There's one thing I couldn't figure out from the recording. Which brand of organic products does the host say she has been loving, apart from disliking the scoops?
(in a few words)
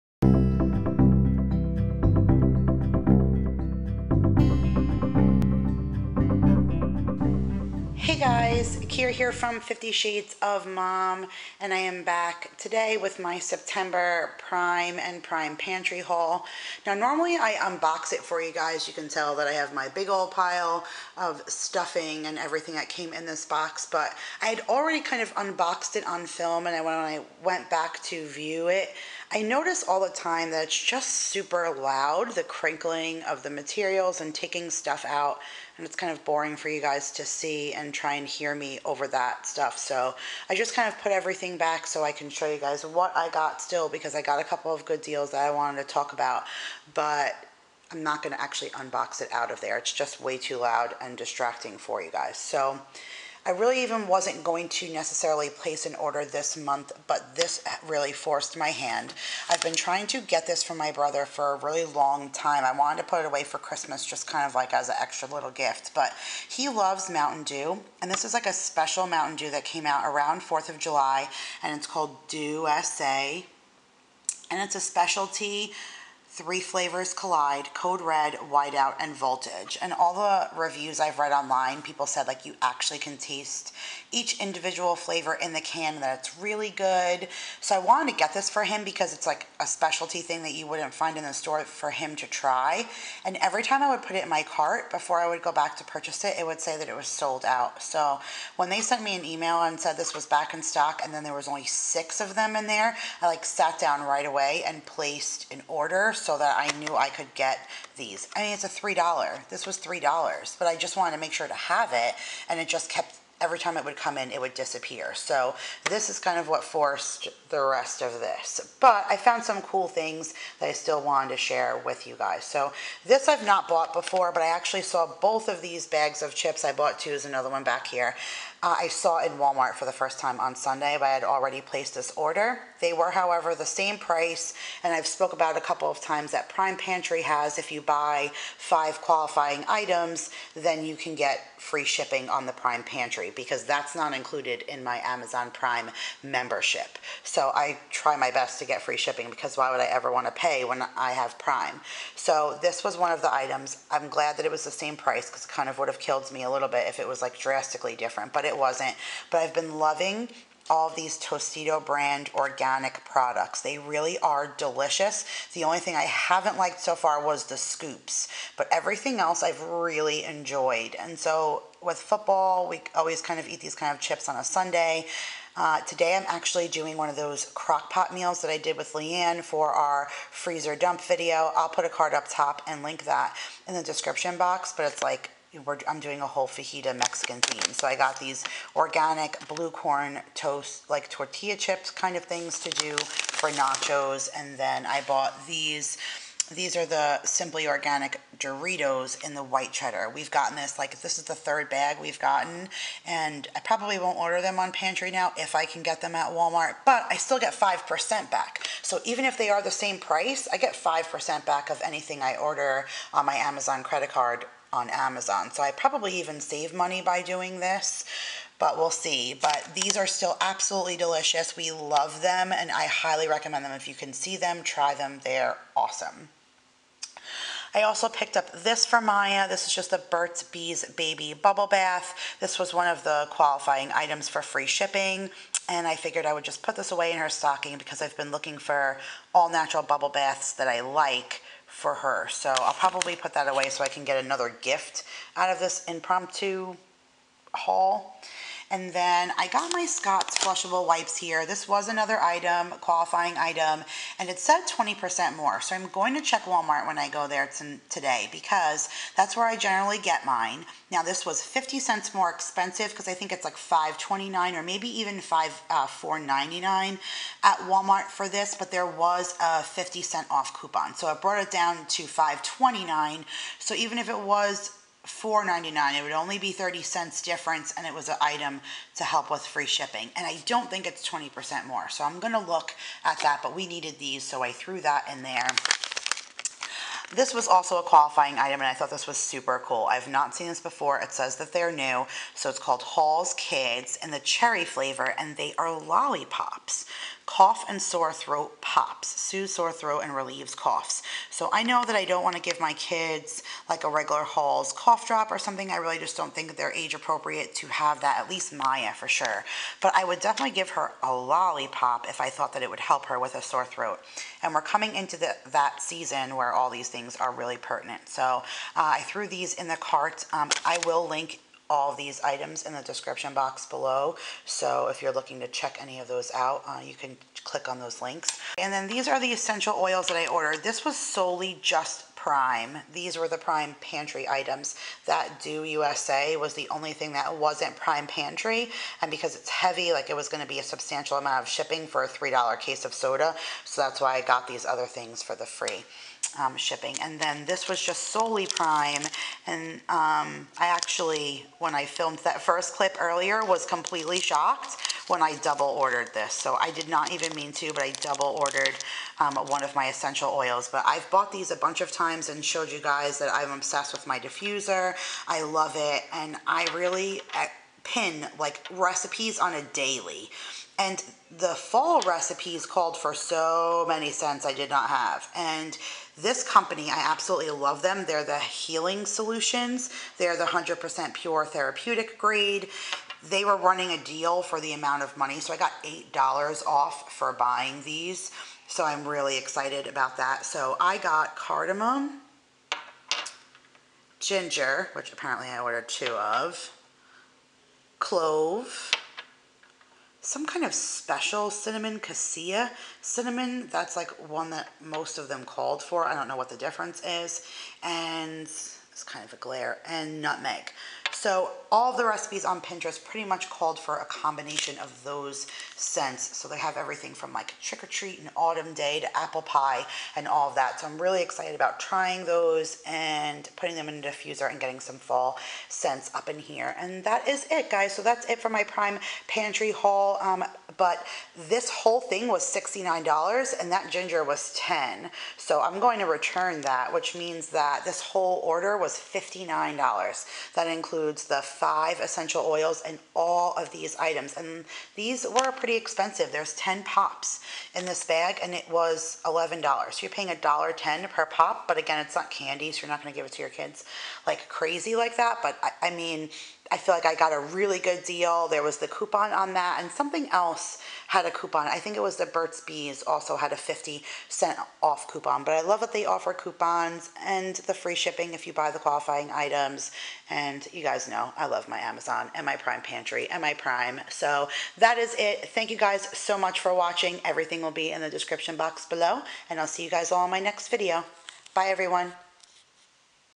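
Tostito.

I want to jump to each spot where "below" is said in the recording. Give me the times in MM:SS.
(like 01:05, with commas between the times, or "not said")
05:23, 07:58.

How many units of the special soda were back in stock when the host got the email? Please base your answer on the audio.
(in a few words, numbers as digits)
6.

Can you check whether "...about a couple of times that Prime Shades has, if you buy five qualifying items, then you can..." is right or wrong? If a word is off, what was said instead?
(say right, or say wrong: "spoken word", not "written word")
wrong: "Pantry", not "Shades".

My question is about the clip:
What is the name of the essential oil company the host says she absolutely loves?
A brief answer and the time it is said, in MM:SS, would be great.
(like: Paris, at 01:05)
Healing Solutions, at 06:18.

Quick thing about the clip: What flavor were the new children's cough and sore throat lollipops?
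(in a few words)
cherry.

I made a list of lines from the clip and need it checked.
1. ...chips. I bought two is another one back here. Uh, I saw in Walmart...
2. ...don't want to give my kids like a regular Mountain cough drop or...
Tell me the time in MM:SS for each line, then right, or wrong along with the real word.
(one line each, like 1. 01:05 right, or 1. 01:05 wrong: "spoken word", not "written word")
1. 02:06 right
2. 05:02 wrong: "Halls", not "Mountain".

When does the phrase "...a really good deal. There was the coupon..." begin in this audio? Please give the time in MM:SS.
07:37.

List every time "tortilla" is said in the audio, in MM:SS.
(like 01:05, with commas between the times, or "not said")
03:11.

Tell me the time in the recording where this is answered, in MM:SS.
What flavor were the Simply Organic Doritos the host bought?
03:19.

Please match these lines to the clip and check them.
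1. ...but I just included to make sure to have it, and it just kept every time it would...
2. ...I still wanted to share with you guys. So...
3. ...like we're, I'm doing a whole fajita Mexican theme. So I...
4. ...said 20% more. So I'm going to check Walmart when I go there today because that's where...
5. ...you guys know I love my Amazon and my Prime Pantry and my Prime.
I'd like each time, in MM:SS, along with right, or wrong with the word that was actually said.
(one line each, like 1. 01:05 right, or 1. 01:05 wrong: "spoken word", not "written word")
1. 01:50 wrong: "wanted", not "included"
2. 02:00 right
3. 03:05 right
4. 04:14 right
5. 07:50 right.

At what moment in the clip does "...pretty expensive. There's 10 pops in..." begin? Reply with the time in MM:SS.
07:25.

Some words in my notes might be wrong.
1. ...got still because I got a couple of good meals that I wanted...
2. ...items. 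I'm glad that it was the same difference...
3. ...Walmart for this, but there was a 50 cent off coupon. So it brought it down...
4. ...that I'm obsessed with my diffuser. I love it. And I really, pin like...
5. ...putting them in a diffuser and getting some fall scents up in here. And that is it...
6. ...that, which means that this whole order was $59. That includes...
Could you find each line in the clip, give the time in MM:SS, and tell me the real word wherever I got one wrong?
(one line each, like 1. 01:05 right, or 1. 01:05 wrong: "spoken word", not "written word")
1. 00:43 wrong: "deals", not "meals"
2. 02:33 wrong: "price", not "difference"
3. 04:27 right
4. 06:03 right
5. 07:03 right
6. 07:16 right.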